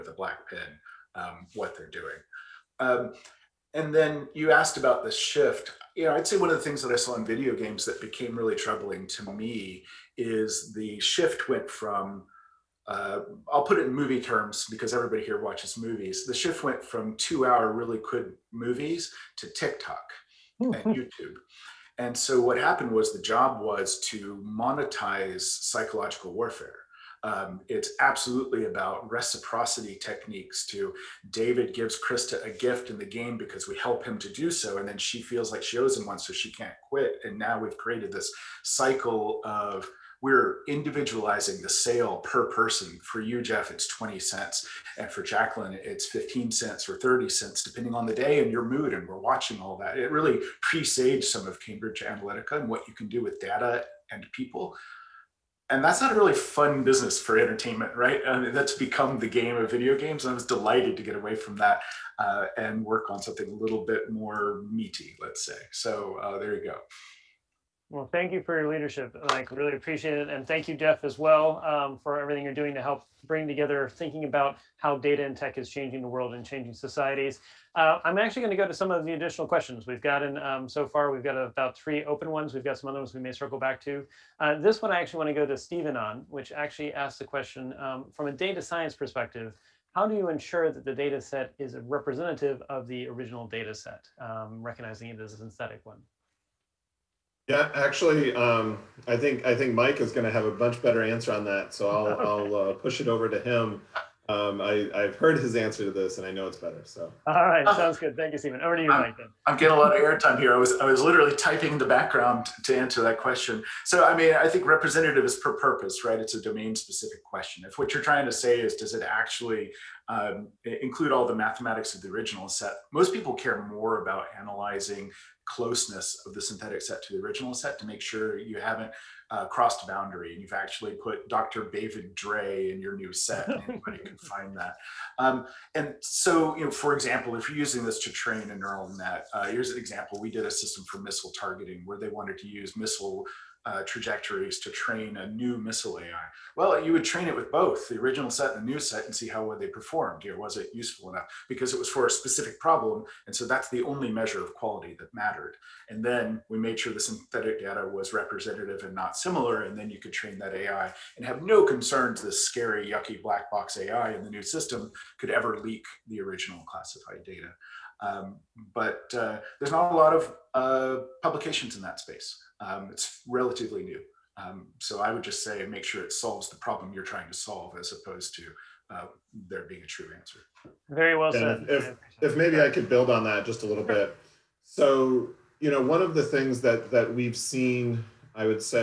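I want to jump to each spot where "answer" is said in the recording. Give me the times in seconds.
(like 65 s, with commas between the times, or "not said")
101 s, 105 s, 112 s, 180 s.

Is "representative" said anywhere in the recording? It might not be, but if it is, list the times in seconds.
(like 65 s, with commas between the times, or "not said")
91 s, 114 s, 158 s.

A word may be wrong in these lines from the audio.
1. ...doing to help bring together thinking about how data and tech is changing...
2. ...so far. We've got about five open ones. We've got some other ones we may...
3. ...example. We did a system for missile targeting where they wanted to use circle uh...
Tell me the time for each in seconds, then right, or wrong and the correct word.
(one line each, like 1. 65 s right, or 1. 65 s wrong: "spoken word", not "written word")
1. 72 s right
2. 80 s wrong: "three", not "five"
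3. 139 s wrong: "missile", not "circle".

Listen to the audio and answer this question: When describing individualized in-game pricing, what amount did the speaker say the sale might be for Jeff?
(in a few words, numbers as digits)
20 cents.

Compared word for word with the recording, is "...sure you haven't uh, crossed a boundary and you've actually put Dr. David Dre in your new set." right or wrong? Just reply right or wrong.
right.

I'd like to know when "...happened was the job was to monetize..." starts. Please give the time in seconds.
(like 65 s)
22 s.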